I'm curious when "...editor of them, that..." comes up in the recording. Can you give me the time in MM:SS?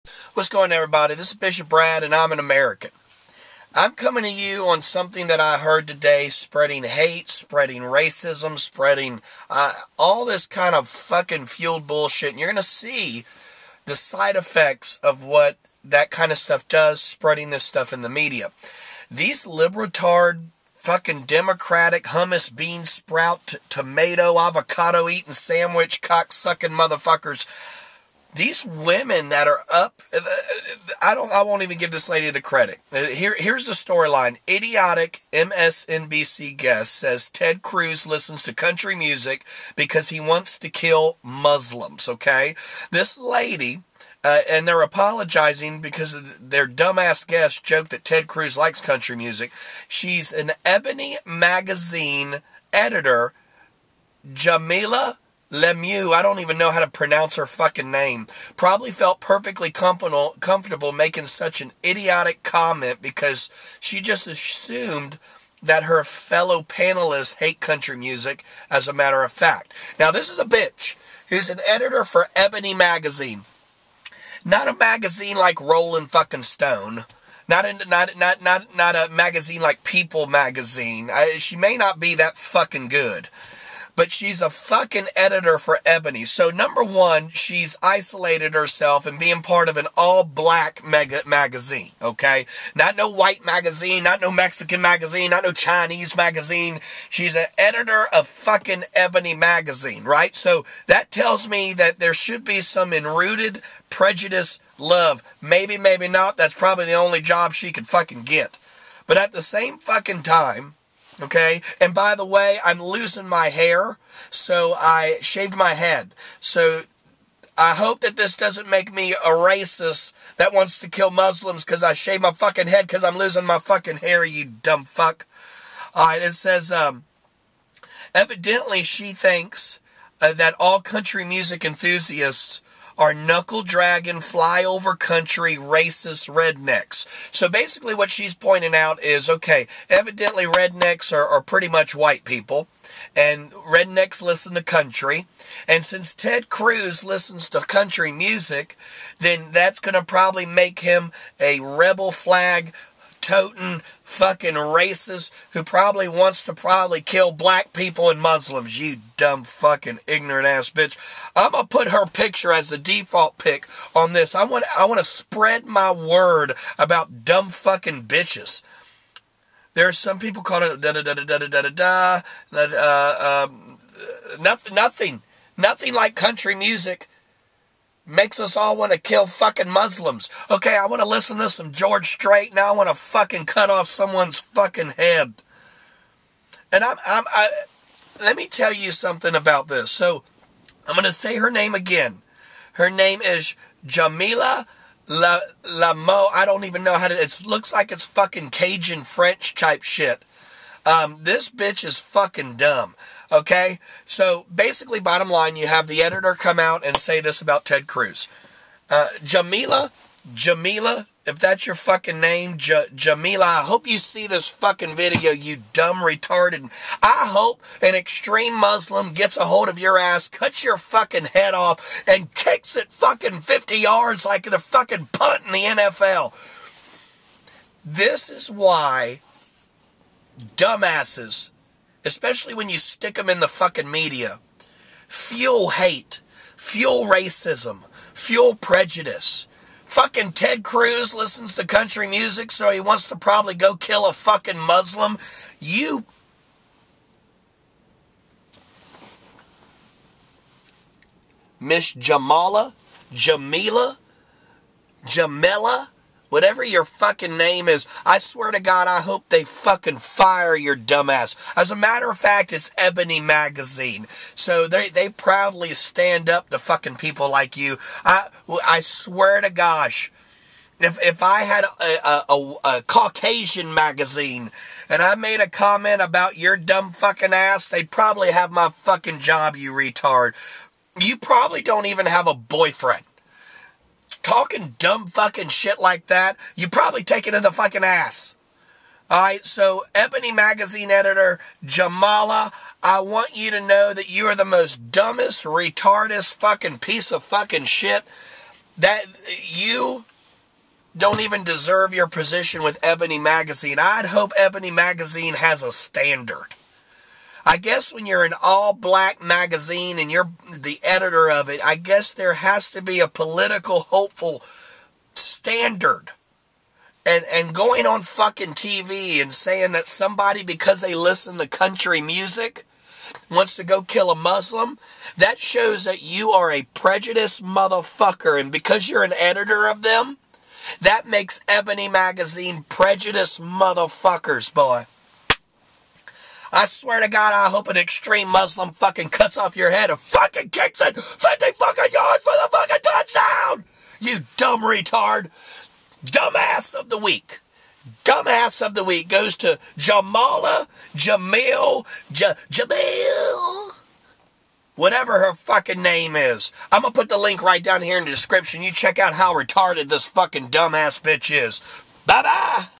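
05:29.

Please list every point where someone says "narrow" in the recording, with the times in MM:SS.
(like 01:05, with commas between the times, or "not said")
not said.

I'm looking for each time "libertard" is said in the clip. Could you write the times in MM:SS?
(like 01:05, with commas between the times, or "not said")
00:19.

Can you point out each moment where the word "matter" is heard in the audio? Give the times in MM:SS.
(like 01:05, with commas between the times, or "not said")
01:08, 04:21.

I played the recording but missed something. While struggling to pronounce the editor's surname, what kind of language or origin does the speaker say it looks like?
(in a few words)
Cajun French.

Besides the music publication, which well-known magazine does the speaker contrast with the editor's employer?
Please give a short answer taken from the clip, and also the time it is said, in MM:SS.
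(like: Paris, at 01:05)
People Magazine, at 01:19.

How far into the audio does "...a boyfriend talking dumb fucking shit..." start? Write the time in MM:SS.
04:42.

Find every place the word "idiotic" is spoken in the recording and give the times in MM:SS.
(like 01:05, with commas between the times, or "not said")
00:34, 01:01.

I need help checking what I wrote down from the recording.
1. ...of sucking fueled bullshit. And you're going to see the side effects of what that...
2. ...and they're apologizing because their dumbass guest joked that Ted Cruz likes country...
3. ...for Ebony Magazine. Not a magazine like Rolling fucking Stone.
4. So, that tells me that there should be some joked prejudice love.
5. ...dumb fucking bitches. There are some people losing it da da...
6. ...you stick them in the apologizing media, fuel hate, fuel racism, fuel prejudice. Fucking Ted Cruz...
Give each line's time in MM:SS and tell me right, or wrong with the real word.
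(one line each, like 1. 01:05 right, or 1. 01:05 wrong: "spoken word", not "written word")
1. 00:10 wrong: "fucking", not "sucking"
2. 00:44 right
3. 01:12 right
4. 01:40 wrong: "enrooted", not "joked"
5. 02:47 wrong: "calling", not "losing"
6. 03:52 wrong: "fucking", not "apologizing".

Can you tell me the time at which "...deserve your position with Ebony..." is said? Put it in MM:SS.
05:01.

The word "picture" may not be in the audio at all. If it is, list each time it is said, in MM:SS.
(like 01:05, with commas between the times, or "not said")
02:42.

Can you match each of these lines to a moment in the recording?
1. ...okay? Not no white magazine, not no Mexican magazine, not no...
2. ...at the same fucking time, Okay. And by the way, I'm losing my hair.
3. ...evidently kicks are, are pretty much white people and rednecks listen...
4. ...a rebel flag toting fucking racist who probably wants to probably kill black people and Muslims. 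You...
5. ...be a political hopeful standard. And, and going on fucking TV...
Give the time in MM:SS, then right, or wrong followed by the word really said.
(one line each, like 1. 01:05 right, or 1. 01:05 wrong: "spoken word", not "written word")
1. 01:32 right
2. 01:49 right
3. 02:19 wrong: "rednecks", not "kicks"
4. 02:31 right
5. 05:12 right.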